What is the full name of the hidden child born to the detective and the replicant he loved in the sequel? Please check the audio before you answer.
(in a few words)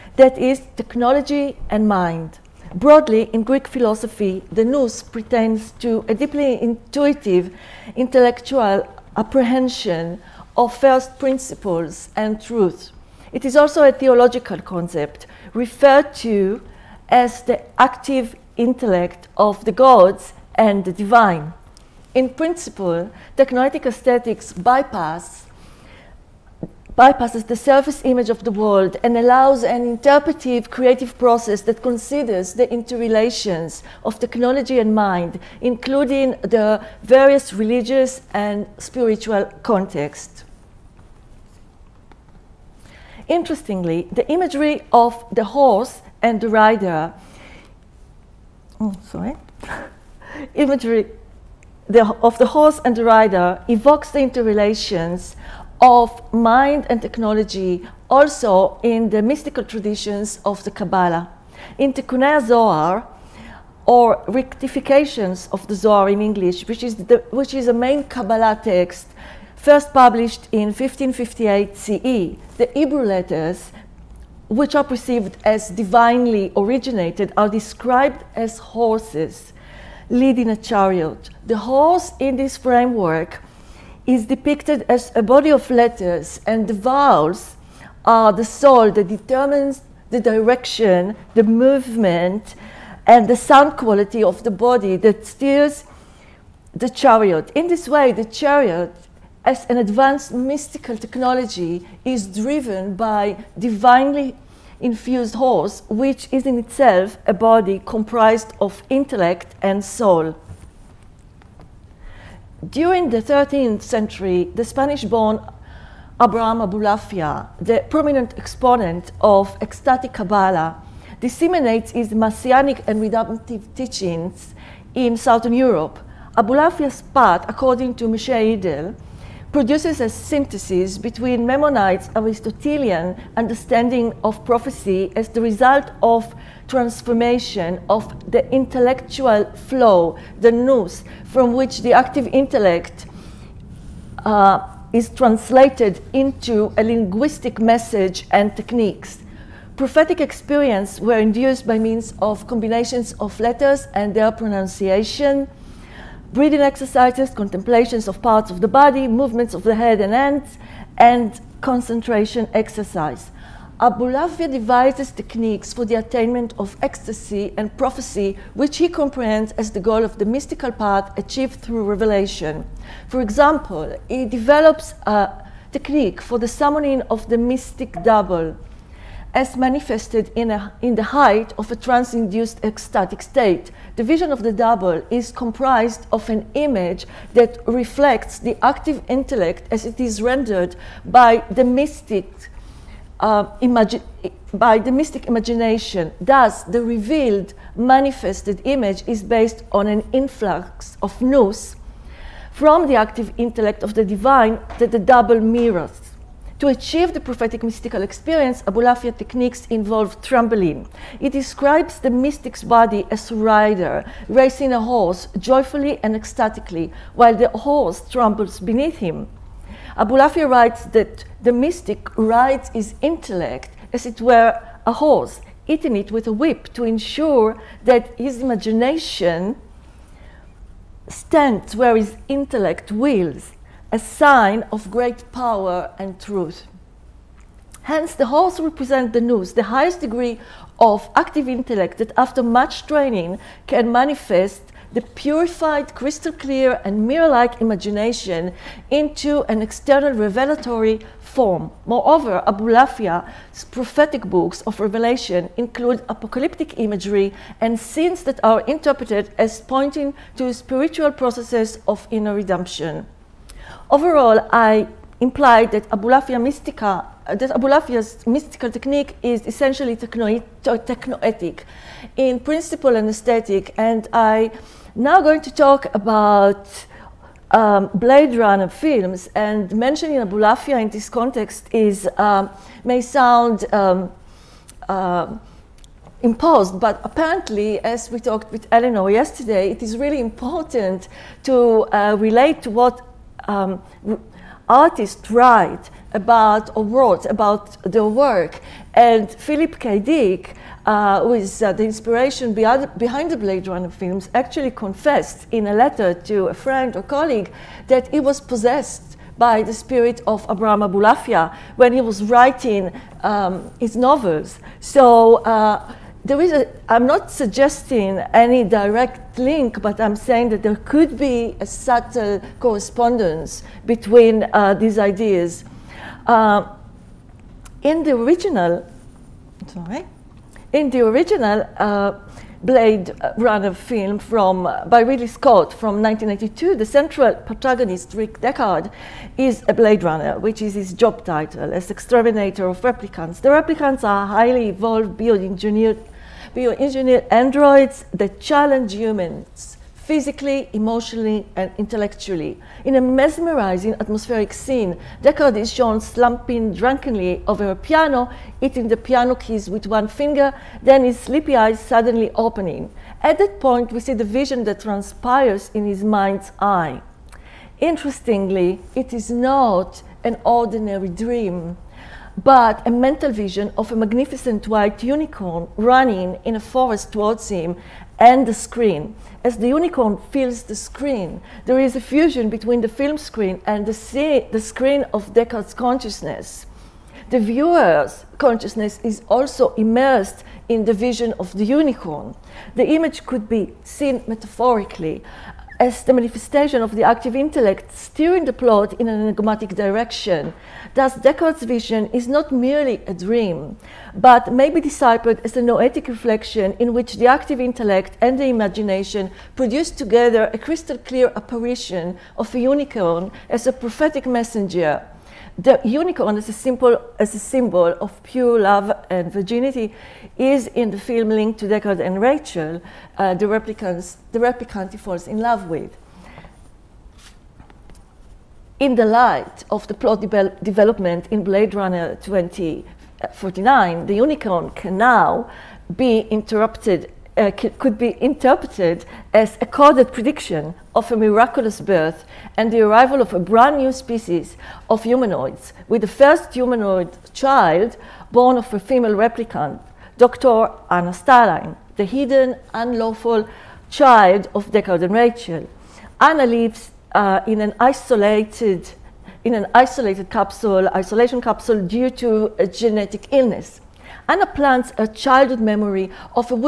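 Dr. Anna Stelline.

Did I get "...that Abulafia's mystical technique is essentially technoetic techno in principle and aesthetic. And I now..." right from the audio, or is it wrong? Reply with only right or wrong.
right.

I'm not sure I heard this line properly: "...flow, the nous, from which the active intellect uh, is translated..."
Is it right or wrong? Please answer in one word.
right.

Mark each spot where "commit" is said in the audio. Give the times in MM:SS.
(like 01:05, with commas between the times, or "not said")
not said.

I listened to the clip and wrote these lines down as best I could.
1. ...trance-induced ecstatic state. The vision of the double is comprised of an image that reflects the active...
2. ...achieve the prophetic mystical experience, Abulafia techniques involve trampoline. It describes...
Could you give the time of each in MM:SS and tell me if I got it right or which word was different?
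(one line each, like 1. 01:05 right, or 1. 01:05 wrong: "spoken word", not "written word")
1. 03:01 right
2. 03:26 right.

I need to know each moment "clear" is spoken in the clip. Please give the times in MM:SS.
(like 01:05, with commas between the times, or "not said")
04:06, 06:50.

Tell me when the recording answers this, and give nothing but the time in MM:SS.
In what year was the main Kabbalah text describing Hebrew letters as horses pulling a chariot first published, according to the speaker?
01:10.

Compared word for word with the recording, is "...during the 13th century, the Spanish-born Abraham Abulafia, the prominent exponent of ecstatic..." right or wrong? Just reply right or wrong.
right.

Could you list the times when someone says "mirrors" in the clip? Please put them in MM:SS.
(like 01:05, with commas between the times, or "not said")
03:25, 04:07.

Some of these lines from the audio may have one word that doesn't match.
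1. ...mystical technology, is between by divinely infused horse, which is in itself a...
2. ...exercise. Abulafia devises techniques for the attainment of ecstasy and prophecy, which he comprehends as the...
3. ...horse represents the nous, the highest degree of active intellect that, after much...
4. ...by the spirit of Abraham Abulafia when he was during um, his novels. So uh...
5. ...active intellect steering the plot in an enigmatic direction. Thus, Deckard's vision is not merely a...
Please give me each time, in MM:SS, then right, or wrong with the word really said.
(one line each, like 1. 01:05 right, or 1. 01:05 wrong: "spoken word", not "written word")
1. 01:40 wrong: "driven", not "between"
2. 02:42 right
3. 03:58 right
4. 05:09 wrong: "writing", not "during"
5. 06:37 right.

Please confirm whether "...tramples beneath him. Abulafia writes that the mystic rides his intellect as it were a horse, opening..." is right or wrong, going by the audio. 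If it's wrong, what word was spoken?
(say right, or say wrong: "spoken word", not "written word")
wrong: "hitting", not "opening".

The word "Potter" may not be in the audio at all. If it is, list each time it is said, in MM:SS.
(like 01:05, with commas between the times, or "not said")
not said.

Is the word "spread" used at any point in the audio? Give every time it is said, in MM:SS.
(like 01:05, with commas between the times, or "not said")
not said.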